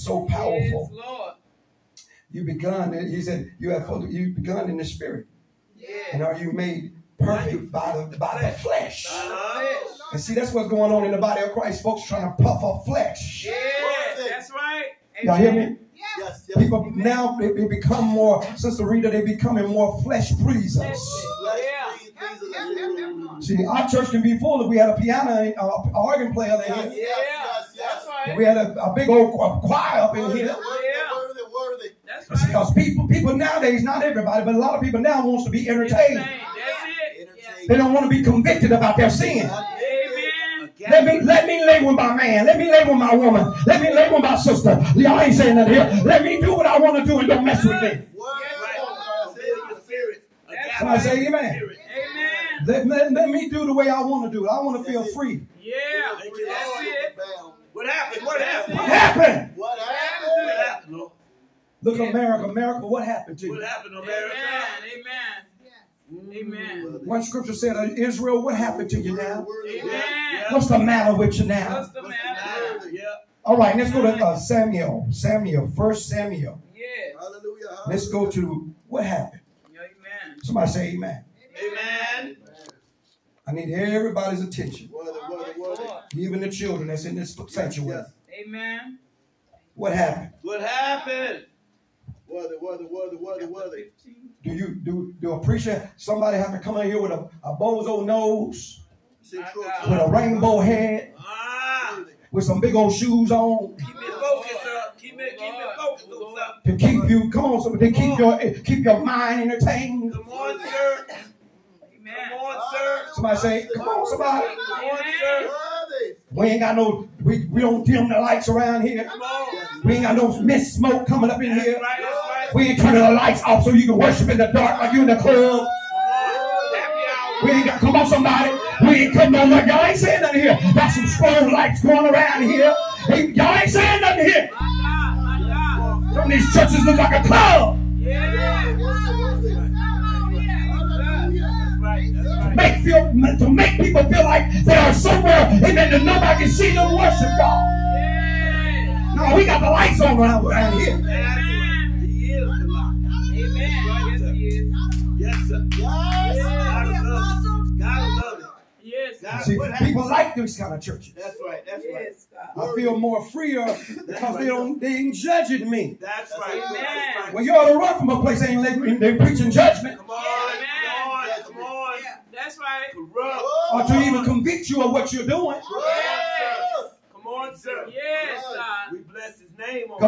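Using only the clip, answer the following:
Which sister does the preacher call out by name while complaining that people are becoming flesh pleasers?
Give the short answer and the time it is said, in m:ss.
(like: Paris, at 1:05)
Sister Rita, at 0:18.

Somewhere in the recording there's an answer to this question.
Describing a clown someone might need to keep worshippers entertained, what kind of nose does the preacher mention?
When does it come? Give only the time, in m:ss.
1:37.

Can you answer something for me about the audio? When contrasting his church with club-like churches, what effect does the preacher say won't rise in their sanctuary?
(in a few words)
Mist smoke.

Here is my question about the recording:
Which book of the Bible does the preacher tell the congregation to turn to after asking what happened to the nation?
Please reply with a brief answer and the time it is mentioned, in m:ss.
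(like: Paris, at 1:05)
First Samuel, at 1:15.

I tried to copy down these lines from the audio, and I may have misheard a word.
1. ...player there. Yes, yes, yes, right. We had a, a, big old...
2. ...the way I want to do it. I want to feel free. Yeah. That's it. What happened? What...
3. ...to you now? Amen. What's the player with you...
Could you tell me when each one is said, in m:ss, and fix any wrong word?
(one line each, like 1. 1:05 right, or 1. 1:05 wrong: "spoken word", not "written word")
1. 0:26 right
2. 0:53 right
3. 1:08 wrong: "matter", not "player".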